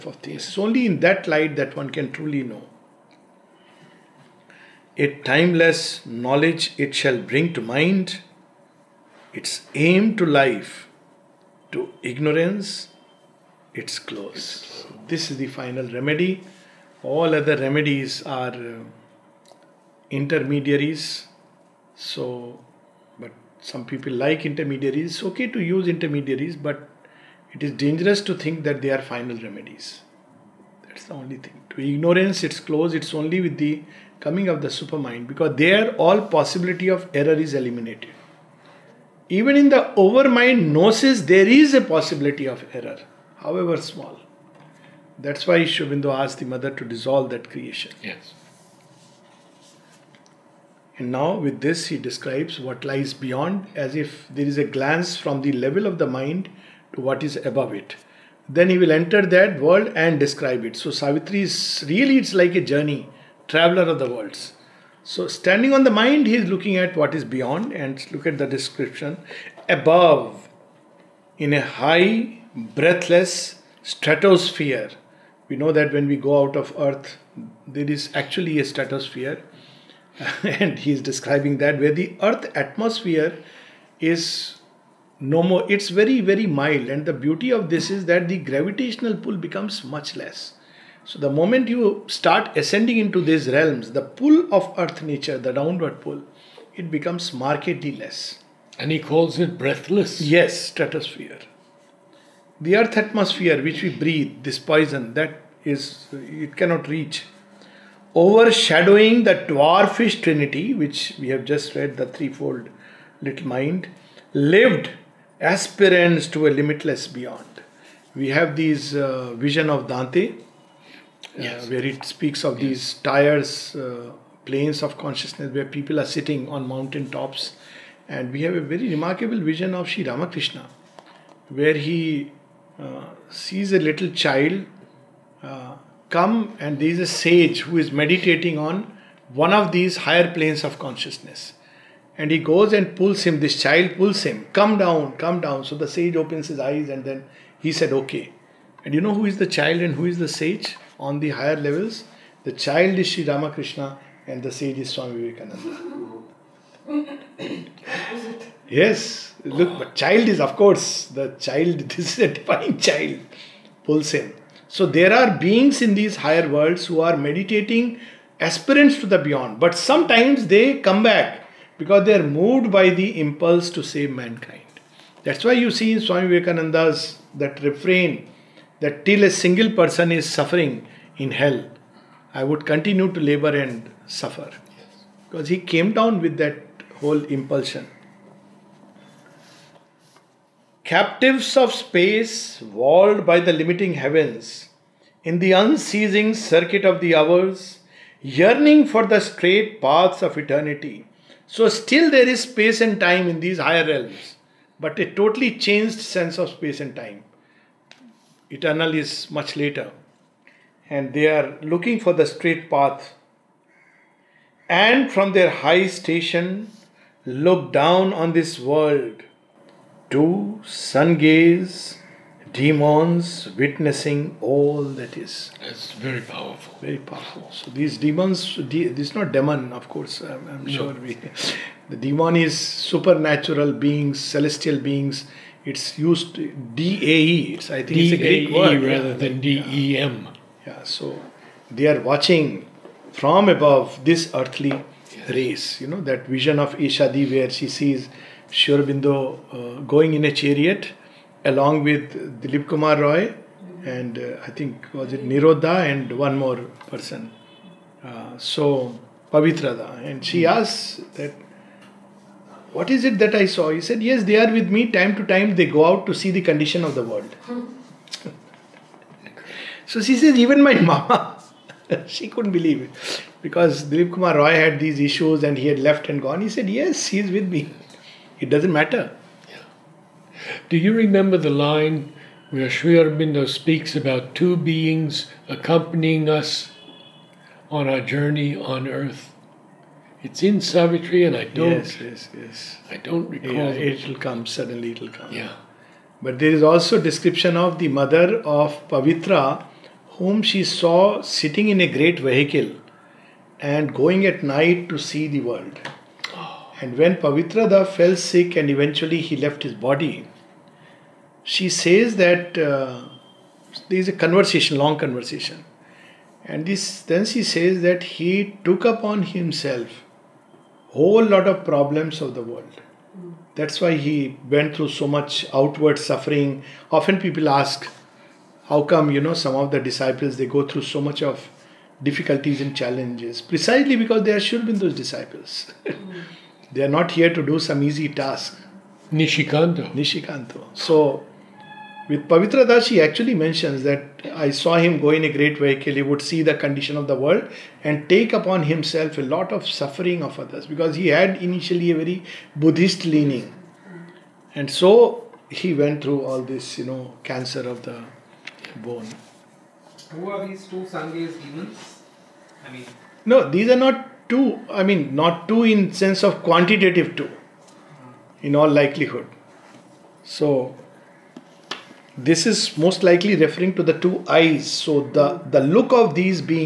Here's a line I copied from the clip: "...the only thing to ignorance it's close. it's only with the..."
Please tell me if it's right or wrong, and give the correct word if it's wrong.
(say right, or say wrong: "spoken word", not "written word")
right.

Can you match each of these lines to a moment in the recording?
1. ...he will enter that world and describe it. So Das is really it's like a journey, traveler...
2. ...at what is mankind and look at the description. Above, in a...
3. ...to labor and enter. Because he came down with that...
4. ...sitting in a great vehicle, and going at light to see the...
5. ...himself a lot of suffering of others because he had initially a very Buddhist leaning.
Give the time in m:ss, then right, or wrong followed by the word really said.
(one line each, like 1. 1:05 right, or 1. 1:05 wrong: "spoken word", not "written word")
1. 0:58 wrong: "Savitri", not "Das"
2. 1:06 wrong: "beyond", not "mankind"
3. 3:03 wrong: "suffer", not "enter"
4. 5:01 wrong: "night", not "light"
5. 5:48 right.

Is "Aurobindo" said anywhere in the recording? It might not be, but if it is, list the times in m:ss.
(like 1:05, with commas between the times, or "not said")
0:45, 4:08, 4:42.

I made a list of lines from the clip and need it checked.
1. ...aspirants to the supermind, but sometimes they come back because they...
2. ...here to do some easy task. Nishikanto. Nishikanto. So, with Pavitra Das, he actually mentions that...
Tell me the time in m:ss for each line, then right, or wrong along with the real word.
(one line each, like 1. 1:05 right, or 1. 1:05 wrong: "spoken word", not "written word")
1. 2:48 wrong: "beyond", not "supermind"
2. 5:37 right.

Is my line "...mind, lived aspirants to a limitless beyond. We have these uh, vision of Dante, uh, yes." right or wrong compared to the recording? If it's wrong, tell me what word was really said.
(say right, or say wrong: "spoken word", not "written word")
right.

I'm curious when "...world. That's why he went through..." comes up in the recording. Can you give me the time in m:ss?
5:22.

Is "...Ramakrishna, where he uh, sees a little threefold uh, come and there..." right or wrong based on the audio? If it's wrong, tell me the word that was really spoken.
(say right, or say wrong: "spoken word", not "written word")
wrong: "child", not "threefold".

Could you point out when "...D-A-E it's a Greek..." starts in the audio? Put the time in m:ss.
3:57.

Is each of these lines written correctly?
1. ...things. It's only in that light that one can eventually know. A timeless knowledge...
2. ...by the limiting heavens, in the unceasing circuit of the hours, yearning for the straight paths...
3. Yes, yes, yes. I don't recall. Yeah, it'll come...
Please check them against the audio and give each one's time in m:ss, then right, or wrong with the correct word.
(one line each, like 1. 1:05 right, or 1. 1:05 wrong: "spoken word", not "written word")
1. 0:00 wrong: "truly", not "eventually"
2. 3:13 right
3. 4:51 right.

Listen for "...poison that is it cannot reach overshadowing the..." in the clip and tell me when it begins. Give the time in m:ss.
1:44.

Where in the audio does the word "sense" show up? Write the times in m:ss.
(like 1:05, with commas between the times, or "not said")
3:25, 6:06.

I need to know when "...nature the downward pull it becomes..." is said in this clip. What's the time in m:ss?
1:35.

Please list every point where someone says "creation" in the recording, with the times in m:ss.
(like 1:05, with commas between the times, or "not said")
0:47.